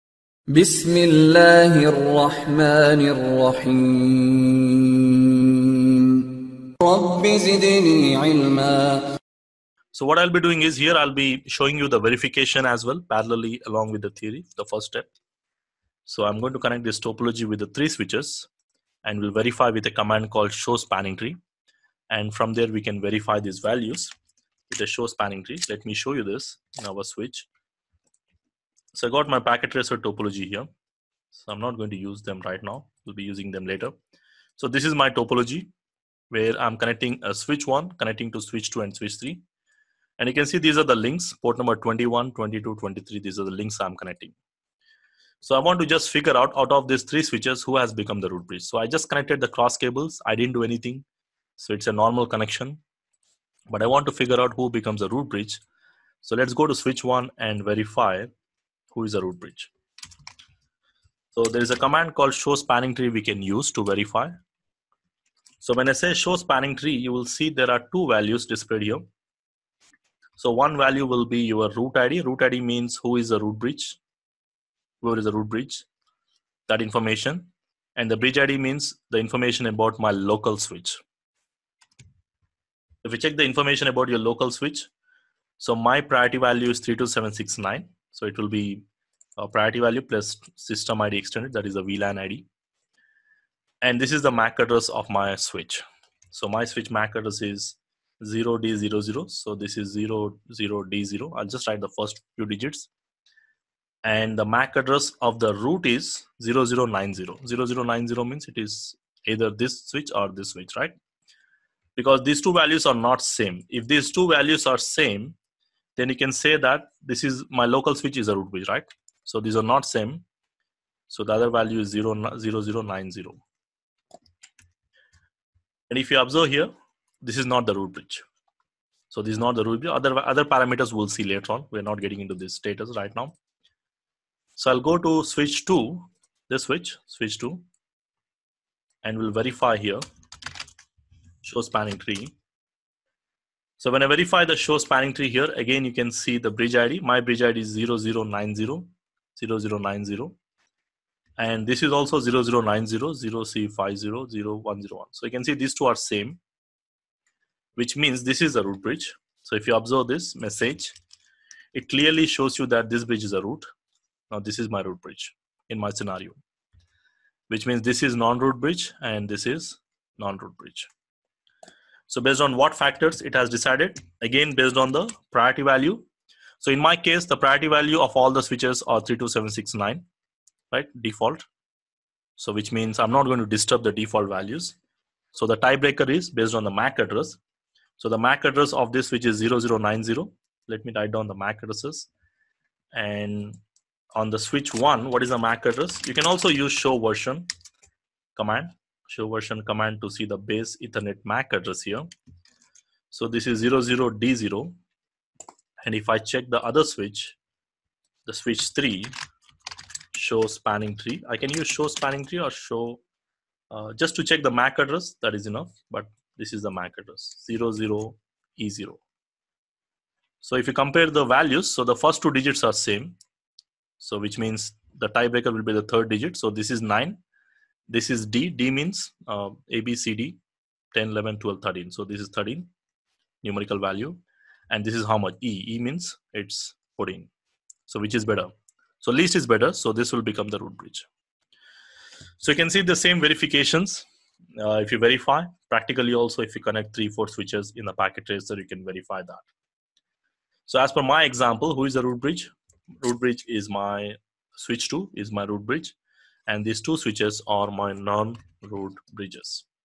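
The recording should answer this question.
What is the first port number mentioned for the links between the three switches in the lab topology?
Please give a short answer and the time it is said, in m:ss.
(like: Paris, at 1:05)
21, at 0:41.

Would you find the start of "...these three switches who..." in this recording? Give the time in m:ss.
0:46.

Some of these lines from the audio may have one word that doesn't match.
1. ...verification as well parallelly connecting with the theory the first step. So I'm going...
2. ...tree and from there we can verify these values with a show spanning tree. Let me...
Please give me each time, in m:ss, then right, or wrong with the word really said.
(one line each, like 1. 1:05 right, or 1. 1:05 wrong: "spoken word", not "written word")
1. 0:12 wrong: "along", not "connecting"
2. 0:21 right.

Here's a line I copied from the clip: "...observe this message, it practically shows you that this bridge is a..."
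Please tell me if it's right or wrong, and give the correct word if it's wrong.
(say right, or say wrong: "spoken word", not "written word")
wrong: "clearly", not "practically".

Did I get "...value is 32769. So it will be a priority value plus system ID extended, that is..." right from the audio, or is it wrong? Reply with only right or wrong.
right.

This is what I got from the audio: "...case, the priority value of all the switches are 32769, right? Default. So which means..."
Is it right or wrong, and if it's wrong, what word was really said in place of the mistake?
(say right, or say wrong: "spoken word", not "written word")
right.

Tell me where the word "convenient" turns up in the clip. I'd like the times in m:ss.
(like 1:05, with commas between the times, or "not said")
not said.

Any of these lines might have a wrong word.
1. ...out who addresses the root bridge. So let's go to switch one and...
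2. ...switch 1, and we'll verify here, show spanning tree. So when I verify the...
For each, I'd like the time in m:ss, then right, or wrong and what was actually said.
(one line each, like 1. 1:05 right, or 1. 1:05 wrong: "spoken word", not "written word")
1. 0:54 wrong: "becomes", not "addresses"
2. 2:17 wrong: "2", not "1".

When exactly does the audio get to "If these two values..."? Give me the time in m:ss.
1:53.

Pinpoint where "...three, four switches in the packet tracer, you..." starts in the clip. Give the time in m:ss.
4:06.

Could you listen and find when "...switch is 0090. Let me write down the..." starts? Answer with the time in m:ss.
3:09.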